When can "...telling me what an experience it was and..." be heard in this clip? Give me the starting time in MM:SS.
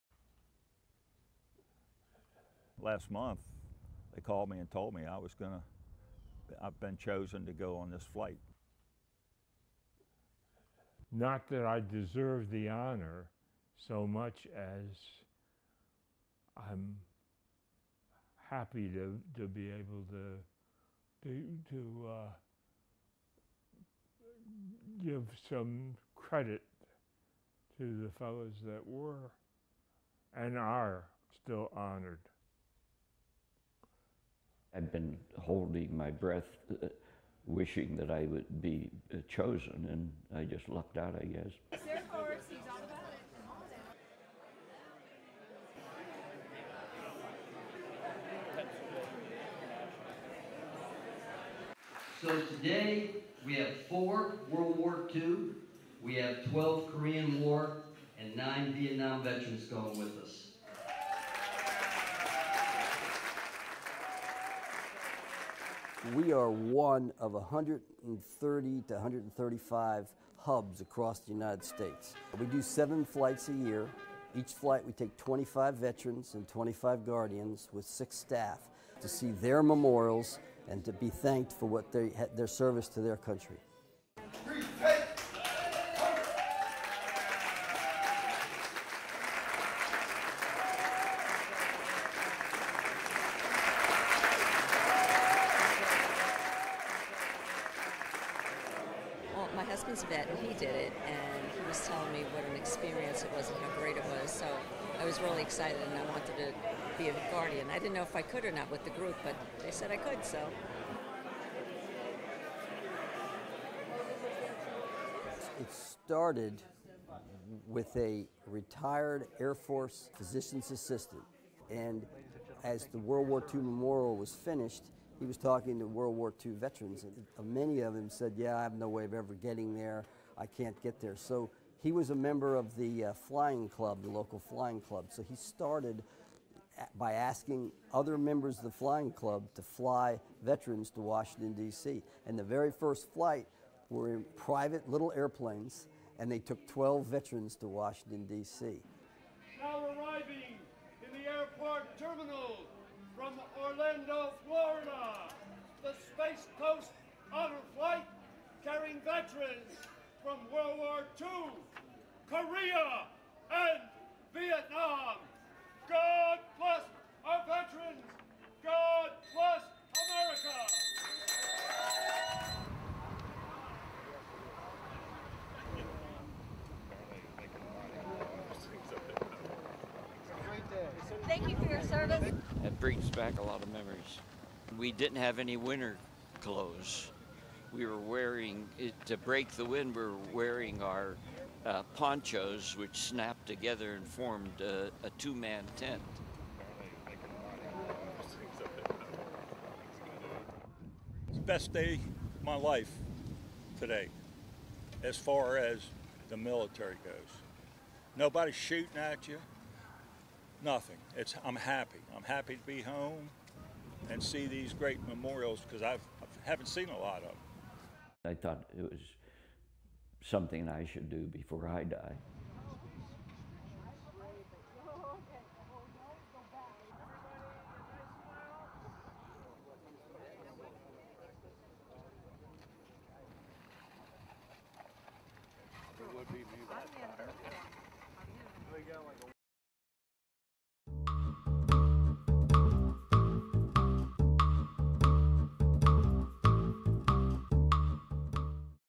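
01:41.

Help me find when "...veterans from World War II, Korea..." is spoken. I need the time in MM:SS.
02:39.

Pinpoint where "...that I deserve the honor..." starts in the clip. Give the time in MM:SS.
00:11.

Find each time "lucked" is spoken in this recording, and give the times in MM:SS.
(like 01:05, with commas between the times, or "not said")
00:40.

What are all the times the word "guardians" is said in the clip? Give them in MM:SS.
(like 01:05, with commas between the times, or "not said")
01:17, 01:47.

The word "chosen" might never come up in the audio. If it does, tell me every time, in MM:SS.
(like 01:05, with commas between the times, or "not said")
00:06, 00:39.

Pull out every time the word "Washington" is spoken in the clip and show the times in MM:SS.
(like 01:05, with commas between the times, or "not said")
02:21, 02:27.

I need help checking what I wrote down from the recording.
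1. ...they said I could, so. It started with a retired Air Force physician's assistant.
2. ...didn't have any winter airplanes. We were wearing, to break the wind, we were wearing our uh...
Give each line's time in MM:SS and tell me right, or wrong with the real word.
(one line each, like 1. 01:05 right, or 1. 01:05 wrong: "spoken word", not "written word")
1. 01:49 right
2. 03:04 wrong: "clothes", not "airplanes".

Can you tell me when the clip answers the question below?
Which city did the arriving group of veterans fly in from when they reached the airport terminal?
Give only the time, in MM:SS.
02:33.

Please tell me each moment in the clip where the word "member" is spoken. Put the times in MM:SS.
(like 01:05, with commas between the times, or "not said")
02:12, 02:18.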